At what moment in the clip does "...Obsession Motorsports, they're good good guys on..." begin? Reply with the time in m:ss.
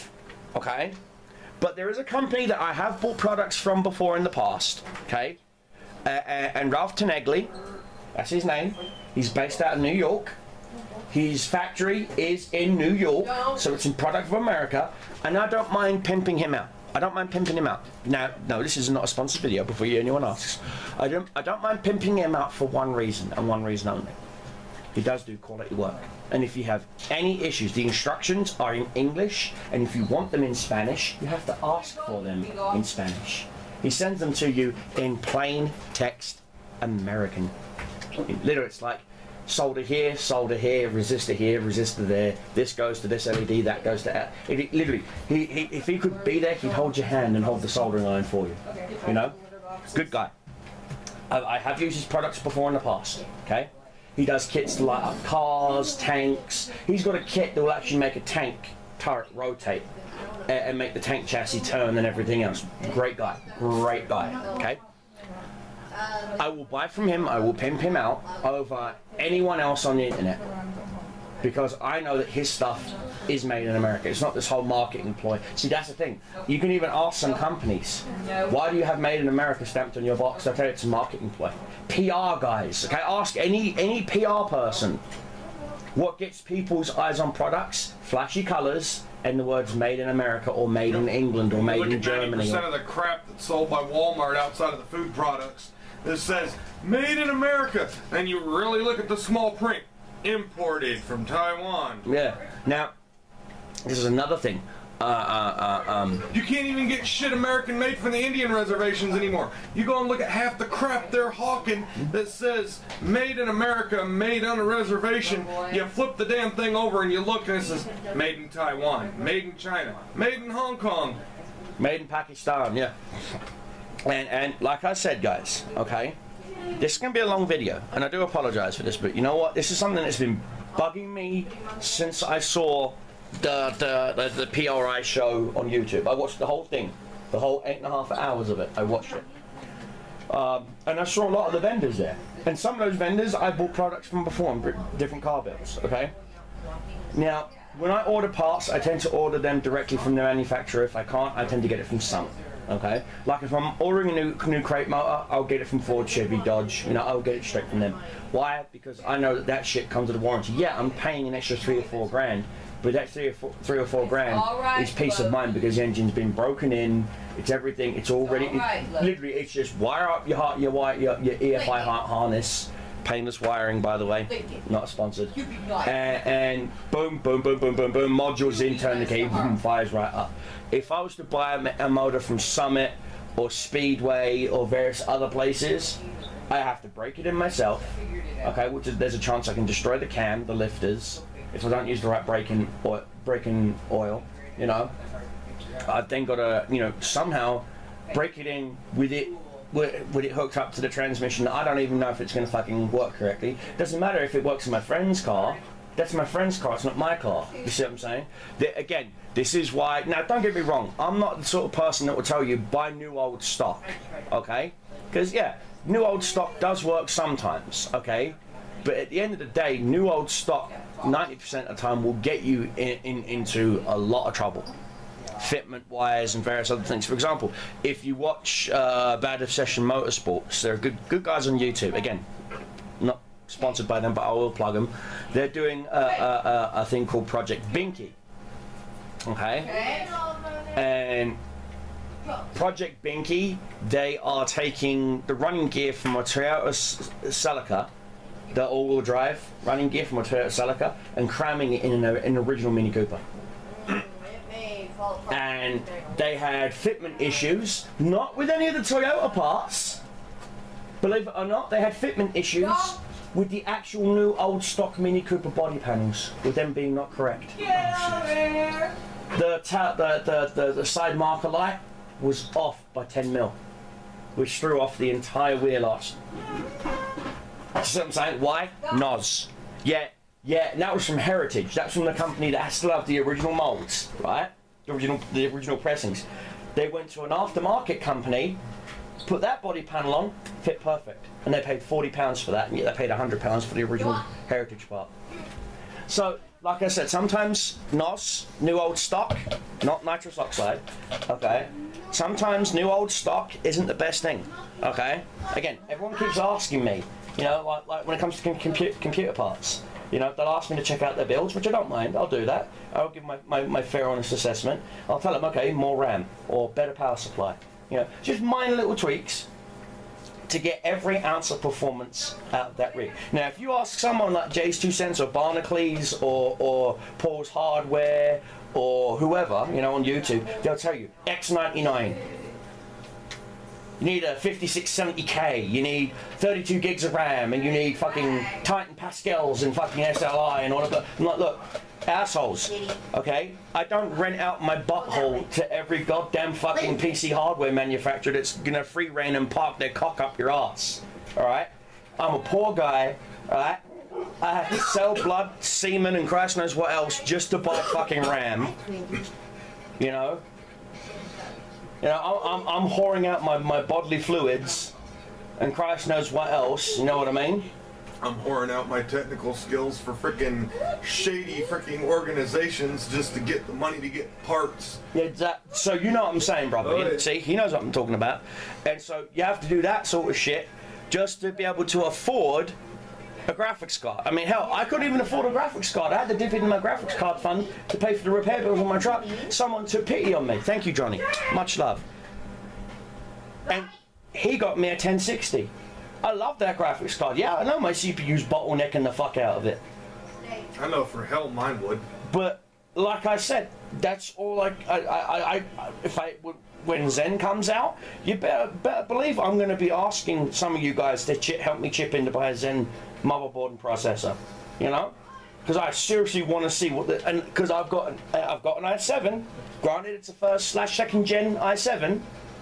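3:49.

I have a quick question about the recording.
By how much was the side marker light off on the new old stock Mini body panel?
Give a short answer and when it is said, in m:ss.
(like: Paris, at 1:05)
10 mil, at 4:33.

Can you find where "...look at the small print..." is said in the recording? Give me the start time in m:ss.
1:38.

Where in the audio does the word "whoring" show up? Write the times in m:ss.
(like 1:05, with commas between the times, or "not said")
6:02, 6:08.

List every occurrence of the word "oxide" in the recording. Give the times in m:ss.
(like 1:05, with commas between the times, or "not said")
5:00.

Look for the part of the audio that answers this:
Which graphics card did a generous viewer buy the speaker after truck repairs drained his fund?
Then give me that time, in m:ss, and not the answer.
6:34.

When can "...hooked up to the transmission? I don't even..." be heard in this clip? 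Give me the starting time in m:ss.
3:20.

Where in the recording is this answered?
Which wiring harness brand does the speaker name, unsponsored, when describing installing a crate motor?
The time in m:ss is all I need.
2:53.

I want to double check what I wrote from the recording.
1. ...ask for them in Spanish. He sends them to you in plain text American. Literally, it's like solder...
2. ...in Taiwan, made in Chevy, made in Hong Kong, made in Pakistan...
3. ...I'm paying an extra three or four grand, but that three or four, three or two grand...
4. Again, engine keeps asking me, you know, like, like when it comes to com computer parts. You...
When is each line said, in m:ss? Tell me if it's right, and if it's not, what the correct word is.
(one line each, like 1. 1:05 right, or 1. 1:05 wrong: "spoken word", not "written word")
1. 0:31 right
2. 1:58 wrong: "China", not "Chevy"
3. 2:40 wrong: "four", not "two"
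4. 5:05 wrong: "everyone", not "engine".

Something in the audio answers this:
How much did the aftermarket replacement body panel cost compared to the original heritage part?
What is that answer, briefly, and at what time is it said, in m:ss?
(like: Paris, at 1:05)
£40, at 4:51.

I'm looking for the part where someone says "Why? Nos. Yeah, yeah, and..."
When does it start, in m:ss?
4:38.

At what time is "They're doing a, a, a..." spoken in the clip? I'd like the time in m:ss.
3:55.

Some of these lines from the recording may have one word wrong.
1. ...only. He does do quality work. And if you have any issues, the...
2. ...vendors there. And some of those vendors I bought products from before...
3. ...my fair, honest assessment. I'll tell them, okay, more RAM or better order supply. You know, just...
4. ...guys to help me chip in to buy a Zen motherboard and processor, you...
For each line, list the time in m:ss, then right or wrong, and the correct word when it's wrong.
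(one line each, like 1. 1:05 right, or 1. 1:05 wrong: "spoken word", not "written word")
1. 0:23 right
2. 2:21 right
3. 5:13 wrong: "power", not "order"
4. 6:50 right.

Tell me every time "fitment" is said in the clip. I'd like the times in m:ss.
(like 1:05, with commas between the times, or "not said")
3:45, 4:16, 4:21.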